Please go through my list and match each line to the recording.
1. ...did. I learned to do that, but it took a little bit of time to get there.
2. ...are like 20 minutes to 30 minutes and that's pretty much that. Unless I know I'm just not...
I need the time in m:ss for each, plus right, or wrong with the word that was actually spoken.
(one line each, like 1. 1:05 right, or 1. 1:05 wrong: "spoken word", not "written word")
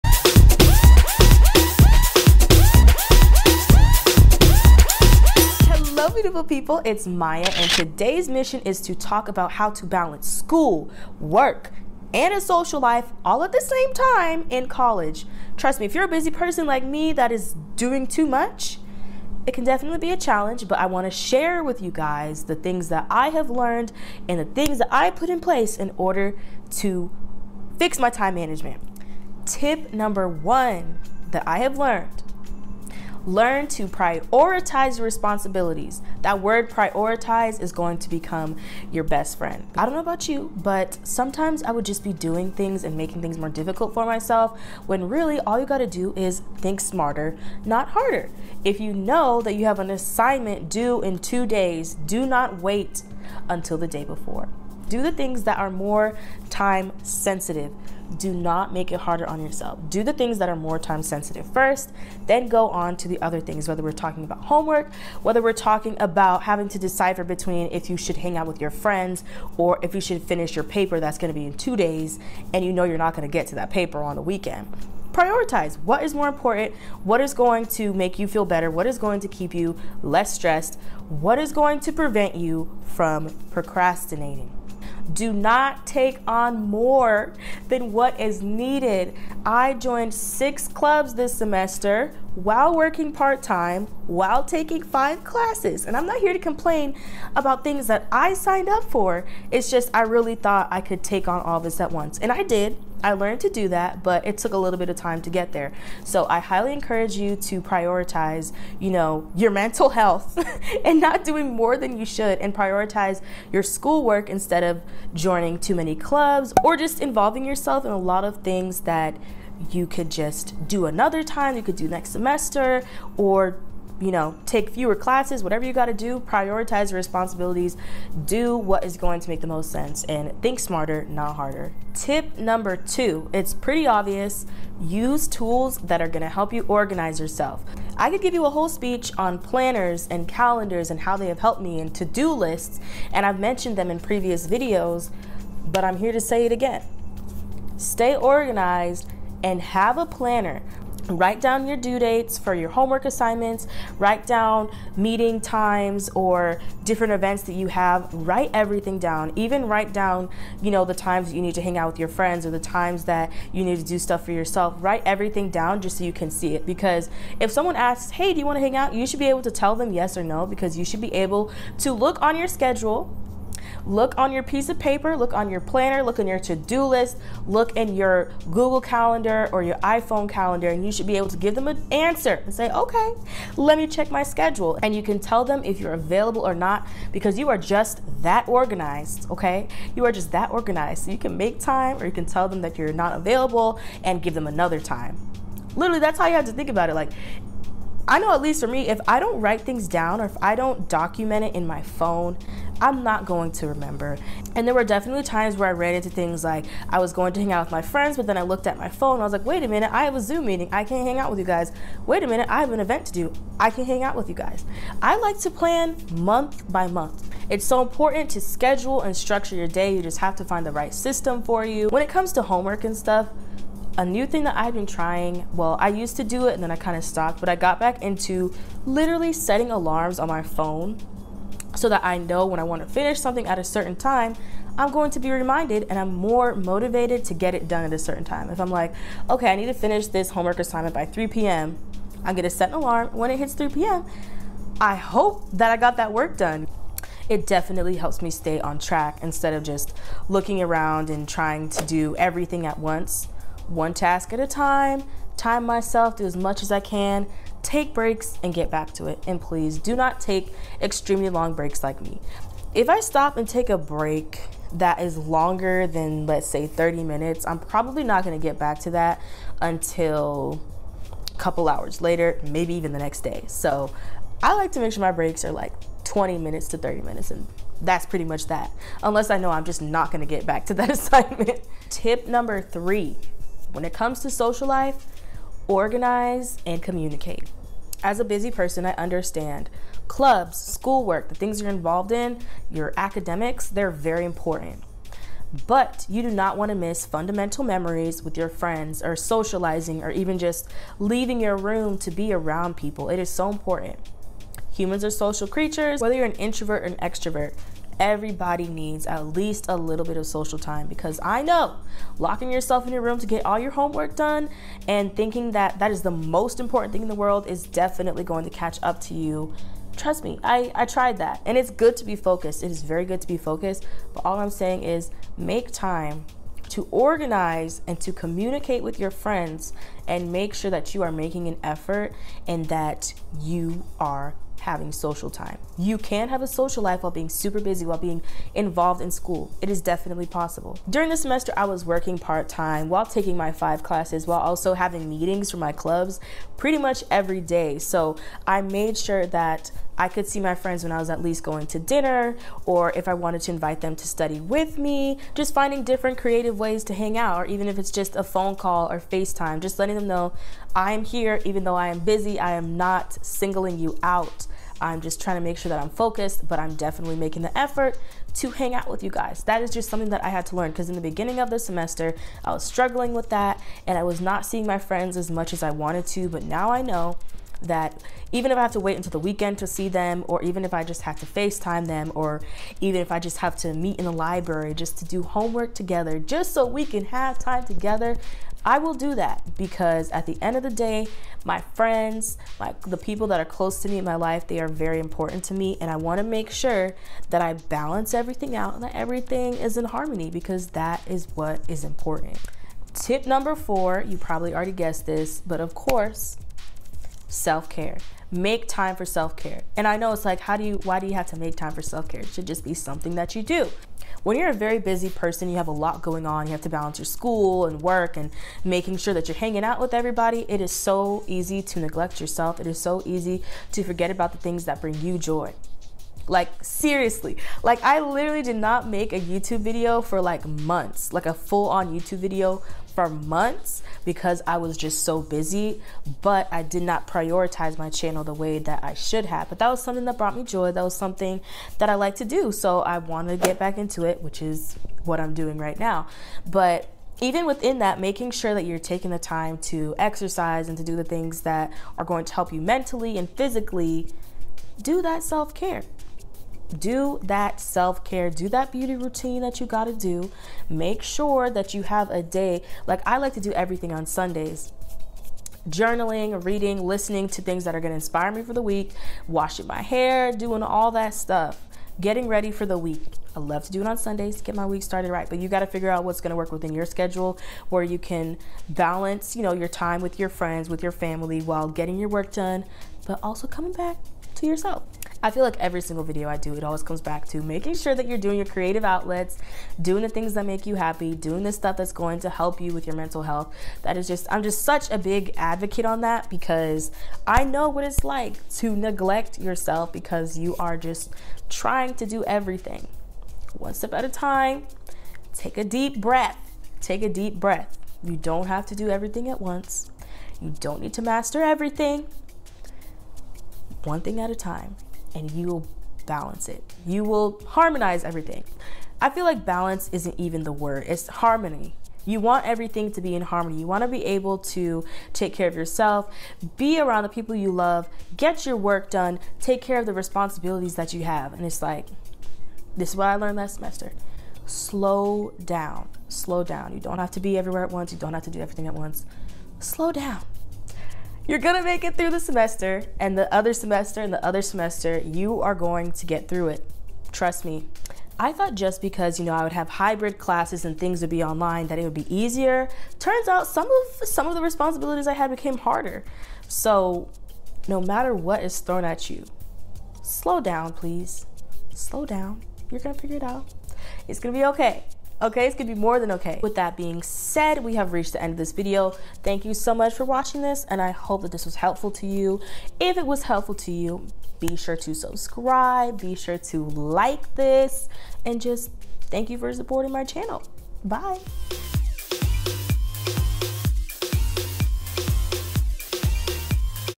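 1. 1:42 right
2. 4:35 right.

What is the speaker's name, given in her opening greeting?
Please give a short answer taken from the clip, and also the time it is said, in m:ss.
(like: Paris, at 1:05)
Maya, at 0:07.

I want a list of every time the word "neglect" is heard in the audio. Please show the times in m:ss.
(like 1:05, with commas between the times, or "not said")
7:01, 8:18.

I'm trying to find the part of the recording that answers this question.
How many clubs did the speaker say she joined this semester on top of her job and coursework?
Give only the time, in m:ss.
1:30.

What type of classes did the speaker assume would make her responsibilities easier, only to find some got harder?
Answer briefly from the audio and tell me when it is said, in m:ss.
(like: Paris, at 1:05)
Hybrid classes, at 9:09.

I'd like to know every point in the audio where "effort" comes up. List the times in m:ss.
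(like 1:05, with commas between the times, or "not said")
5:31, 6:07.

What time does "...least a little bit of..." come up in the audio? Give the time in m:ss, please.
5:09.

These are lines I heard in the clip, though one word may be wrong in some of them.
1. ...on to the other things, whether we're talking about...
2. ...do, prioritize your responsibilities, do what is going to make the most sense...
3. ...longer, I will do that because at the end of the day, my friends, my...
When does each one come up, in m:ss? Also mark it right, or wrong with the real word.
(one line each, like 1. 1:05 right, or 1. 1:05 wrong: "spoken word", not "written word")
1. 1:02 right
2. 2:05 right
3. 6:27 wrong: "together", not "longer".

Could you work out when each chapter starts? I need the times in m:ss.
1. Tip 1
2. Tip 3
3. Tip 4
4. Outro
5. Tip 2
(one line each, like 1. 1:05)
1. 0:30
2. 4:42
3. 6:43
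4. 9:27
5. 2:12.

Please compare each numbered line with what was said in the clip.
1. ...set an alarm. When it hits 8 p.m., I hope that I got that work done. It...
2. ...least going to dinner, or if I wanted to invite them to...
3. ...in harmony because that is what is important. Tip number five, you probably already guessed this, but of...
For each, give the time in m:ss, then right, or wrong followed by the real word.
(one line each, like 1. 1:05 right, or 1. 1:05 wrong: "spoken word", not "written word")
1. 4:02 wrong: "3", not "8"
2. 5:51 right
3. 6:39 wrong: "four", not "five".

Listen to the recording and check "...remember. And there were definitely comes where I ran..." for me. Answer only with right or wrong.
wrong.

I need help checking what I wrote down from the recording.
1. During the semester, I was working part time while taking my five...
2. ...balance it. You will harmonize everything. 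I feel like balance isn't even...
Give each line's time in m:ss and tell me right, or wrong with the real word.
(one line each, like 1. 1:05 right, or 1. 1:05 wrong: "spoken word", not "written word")
1. 5:40 right
2. 8:36 right.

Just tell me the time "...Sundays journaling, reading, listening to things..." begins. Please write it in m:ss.
7:44.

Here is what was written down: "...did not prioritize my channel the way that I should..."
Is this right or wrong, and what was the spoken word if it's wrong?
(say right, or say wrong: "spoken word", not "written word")
right.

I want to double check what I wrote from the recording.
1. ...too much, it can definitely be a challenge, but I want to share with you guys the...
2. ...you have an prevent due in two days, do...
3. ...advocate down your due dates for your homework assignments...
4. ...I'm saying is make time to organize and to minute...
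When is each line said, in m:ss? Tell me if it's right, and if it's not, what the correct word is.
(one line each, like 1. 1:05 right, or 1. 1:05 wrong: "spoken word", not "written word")
1. 0:18 right
2. 0:49 wrong: "assignment", not "prevent"
3. 2:31 wrong: "write", not "advocate"
4. 5:24 wrong: "communicate", not "minute".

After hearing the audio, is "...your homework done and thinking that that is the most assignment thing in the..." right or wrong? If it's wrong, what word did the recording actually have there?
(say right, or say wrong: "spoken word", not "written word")
wrong: "important", not "assignment".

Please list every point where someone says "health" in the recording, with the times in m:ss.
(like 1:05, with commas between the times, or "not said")
1:49, 8:13.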